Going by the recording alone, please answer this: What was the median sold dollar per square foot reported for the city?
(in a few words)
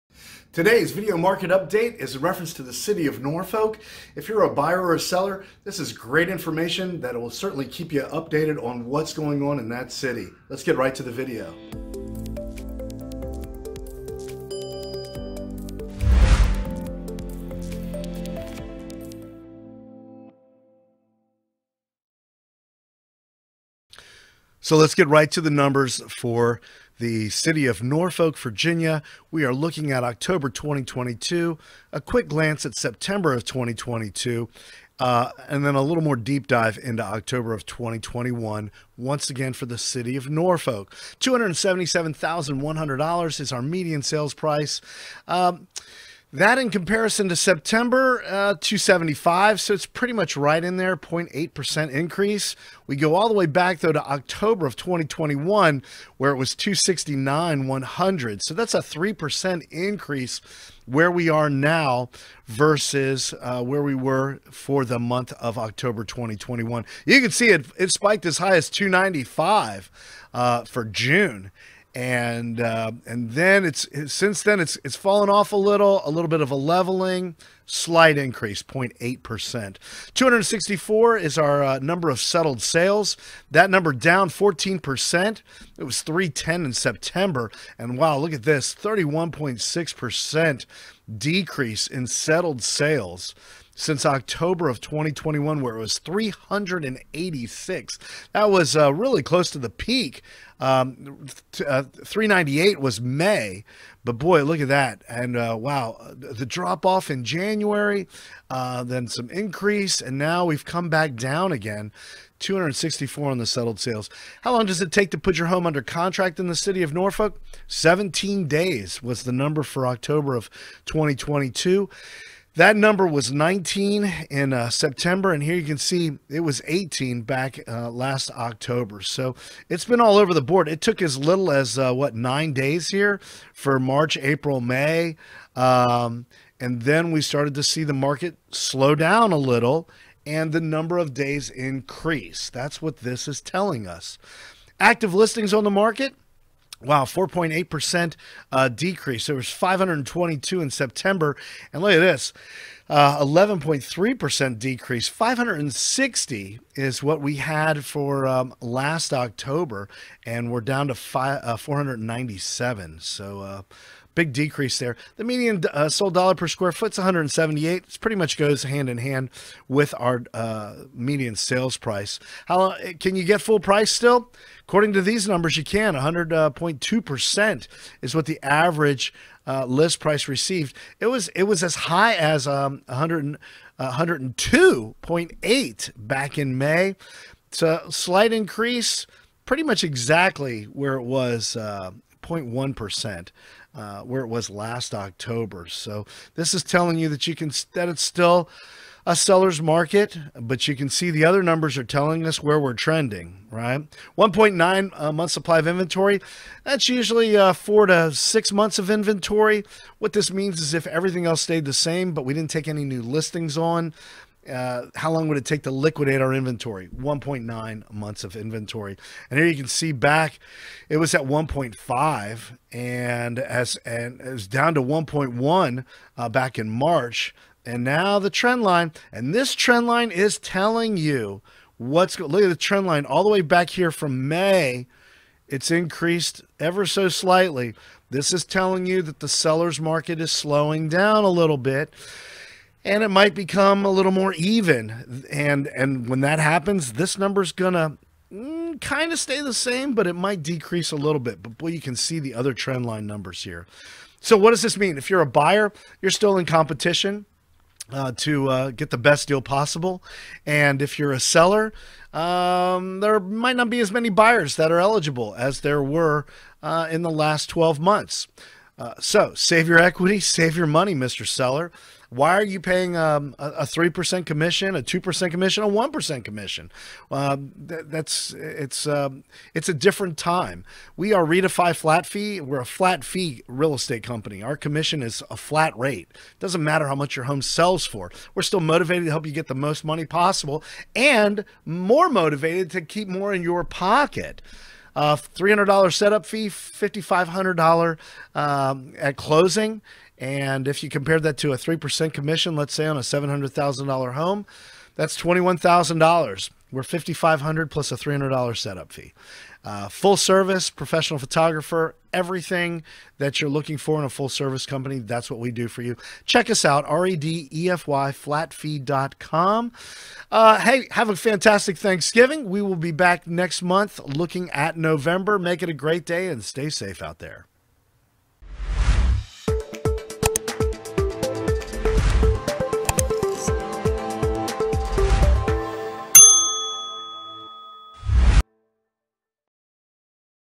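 178.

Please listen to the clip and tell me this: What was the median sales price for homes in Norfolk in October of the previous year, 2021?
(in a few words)
$269,100.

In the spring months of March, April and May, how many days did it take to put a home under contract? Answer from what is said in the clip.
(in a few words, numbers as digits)
9 days.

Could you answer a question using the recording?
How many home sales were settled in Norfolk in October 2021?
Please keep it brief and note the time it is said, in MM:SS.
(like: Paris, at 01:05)
386, at 01:35.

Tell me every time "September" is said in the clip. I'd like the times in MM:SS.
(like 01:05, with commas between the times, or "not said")
00:32, 00:47, 01:26, 02:04, 02:30.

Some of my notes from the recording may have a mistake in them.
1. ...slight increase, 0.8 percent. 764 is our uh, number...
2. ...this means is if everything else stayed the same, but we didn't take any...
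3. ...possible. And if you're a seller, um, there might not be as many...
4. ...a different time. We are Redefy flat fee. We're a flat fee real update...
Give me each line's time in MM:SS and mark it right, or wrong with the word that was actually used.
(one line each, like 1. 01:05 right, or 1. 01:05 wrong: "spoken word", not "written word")
1. 01:17 wrong: "264", not "764"
2. 03:30 right
3. 04:19 right
4. 04:39 wrong: "estate", not "update".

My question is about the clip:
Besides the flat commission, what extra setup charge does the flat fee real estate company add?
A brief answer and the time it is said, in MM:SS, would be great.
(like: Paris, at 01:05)
$300, at 05:07.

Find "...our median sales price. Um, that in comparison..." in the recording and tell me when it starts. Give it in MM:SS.
00:43.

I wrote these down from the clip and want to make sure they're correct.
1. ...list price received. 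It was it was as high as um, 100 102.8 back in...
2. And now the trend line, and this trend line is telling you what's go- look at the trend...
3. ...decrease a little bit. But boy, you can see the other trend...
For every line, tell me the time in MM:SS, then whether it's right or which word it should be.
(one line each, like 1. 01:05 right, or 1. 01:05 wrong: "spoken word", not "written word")
1. 02:59 right
2. 03:47 right
3. 04:10 right.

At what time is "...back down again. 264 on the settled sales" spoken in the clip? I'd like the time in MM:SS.
01:50.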